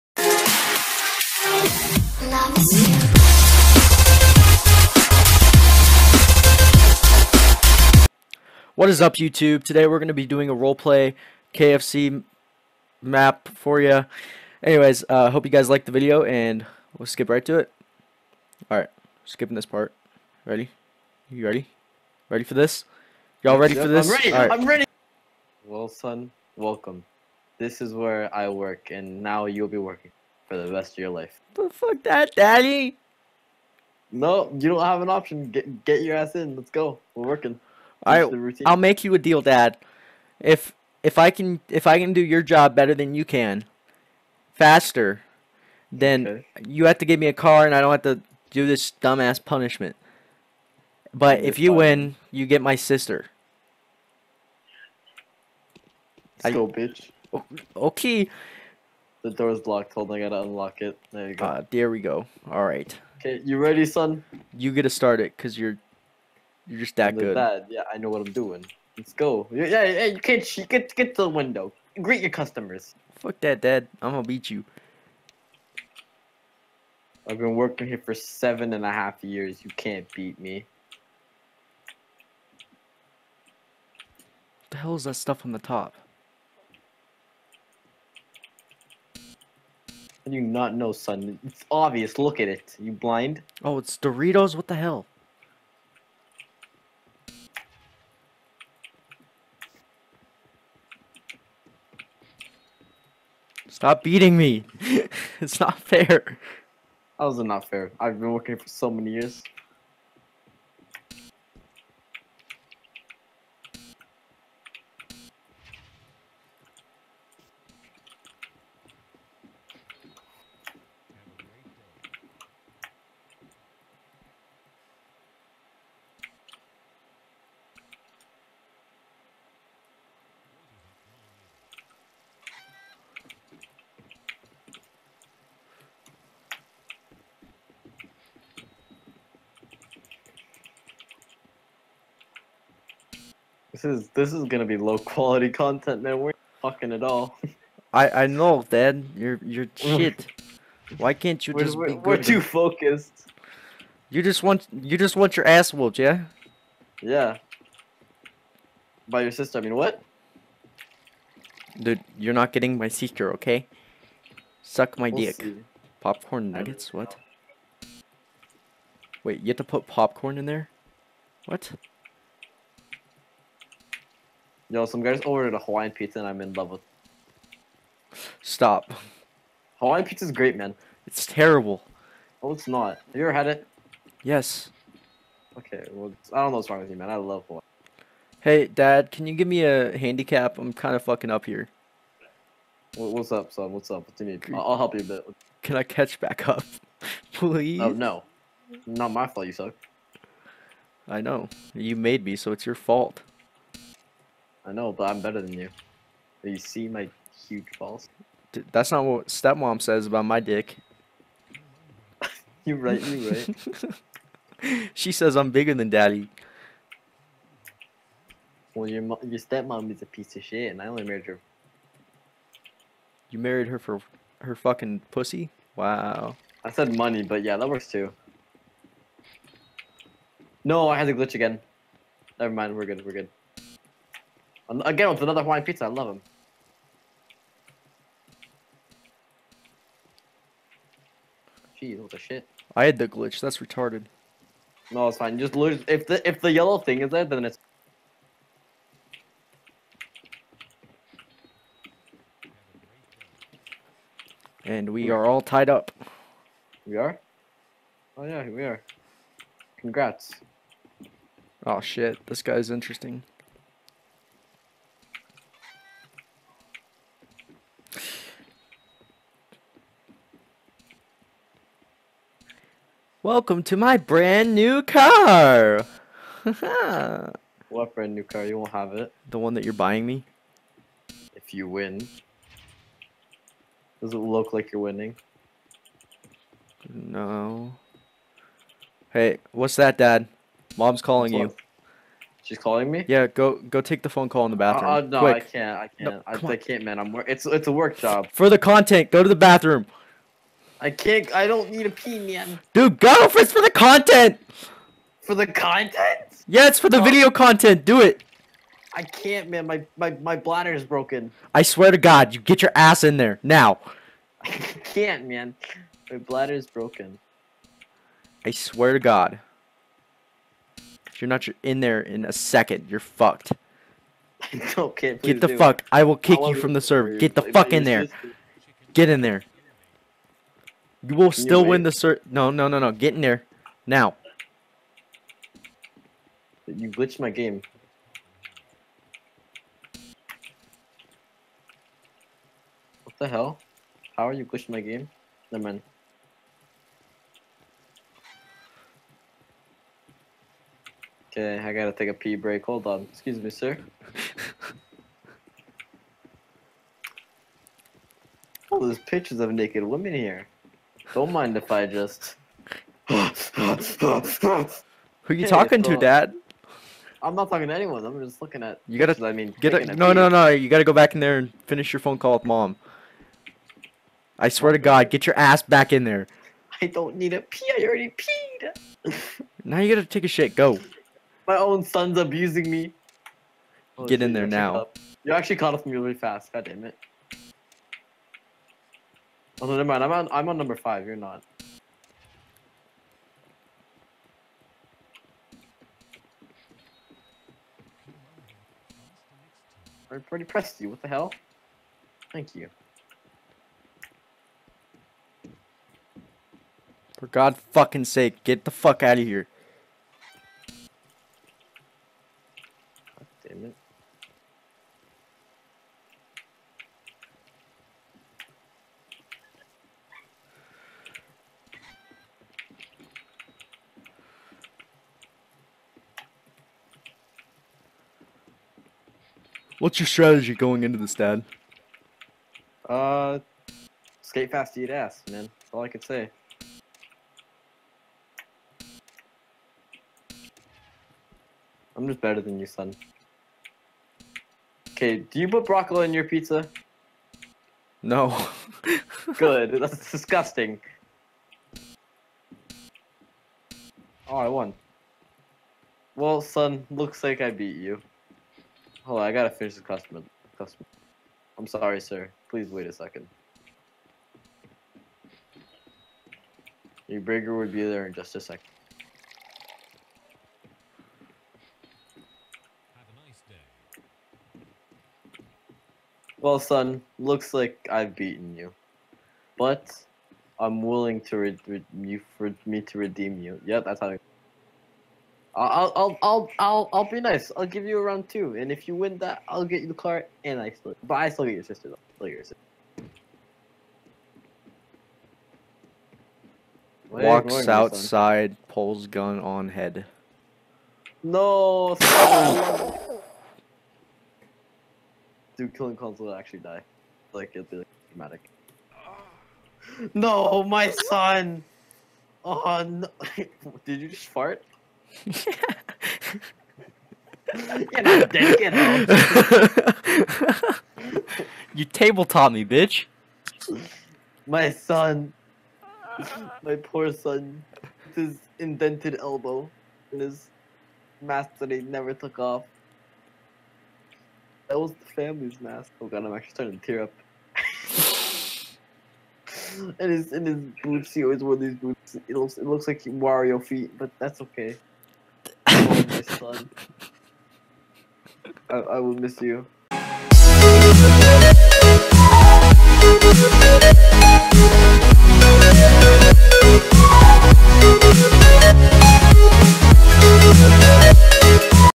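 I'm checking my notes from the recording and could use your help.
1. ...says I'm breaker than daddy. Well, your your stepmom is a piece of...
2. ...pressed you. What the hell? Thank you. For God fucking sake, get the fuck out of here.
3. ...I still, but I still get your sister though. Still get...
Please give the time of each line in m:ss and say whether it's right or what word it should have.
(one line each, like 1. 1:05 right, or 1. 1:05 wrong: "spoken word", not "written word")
1. 3:35 wrong: "bigger", not "breaker"
2. 6:40 right
3. 8:10 right.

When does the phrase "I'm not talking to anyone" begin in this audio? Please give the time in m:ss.
6:07.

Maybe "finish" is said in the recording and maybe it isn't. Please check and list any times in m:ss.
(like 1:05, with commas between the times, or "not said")
6:11, 7:39.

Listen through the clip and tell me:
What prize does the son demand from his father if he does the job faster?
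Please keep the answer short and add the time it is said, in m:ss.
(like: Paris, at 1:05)
A car, at 0:47.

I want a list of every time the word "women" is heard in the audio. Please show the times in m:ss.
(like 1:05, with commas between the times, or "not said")
5:59.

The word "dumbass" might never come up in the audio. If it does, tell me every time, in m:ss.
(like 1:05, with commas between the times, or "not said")
0:49.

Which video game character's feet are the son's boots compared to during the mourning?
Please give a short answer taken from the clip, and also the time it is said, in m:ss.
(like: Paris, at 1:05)
Wario, at 9:03.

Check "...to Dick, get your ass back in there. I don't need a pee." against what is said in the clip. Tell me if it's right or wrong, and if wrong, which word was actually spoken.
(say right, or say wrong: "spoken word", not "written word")
wrong: "God", not "Dick".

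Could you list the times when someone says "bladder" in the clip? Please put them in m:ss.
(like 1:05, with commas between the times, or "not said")
5:10, 5:16.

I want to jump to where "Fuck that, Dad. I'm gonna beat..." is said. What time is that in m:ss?
1:13.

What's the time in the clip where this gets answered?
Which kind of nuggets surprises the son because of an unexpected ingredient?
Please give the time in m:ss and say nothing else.
2:46.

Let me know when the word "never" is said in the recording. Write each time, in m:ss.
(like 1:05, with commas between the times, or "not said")
3:52, 5:45, 6:29, 8:51.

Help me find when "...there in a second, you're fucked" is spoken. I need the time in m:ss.
5:21.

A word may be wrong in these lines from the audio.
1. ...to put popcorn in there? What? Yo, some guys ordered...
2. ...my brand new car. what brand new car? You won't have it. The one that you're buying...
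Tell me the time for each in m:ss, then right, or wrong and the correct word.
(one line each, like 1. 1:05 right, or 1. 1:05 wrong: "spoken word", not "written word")
1. 2:49 right
2. 4:33 right.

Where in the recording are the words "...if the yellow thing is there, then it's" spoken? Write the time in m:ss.
4:06.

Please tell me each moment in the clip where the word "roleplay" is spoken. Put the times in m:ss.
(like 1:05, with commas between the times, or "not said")
0:10.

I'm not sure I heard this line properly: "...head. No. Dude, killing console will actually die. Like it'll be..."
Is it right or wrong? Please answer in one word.
right.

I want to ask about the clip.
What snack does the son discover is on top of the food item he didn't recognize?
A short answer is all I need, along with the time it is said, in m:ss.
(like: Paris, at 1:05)
Doritos, at 1:33.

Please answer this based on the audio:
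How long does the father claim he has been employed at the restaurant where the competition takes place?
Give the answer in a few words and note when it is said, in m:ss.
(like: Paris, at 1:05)
7.5 years, at 1:18.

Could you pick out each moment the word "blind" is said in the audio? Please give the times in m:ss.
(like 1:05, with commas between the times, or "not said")
1:32.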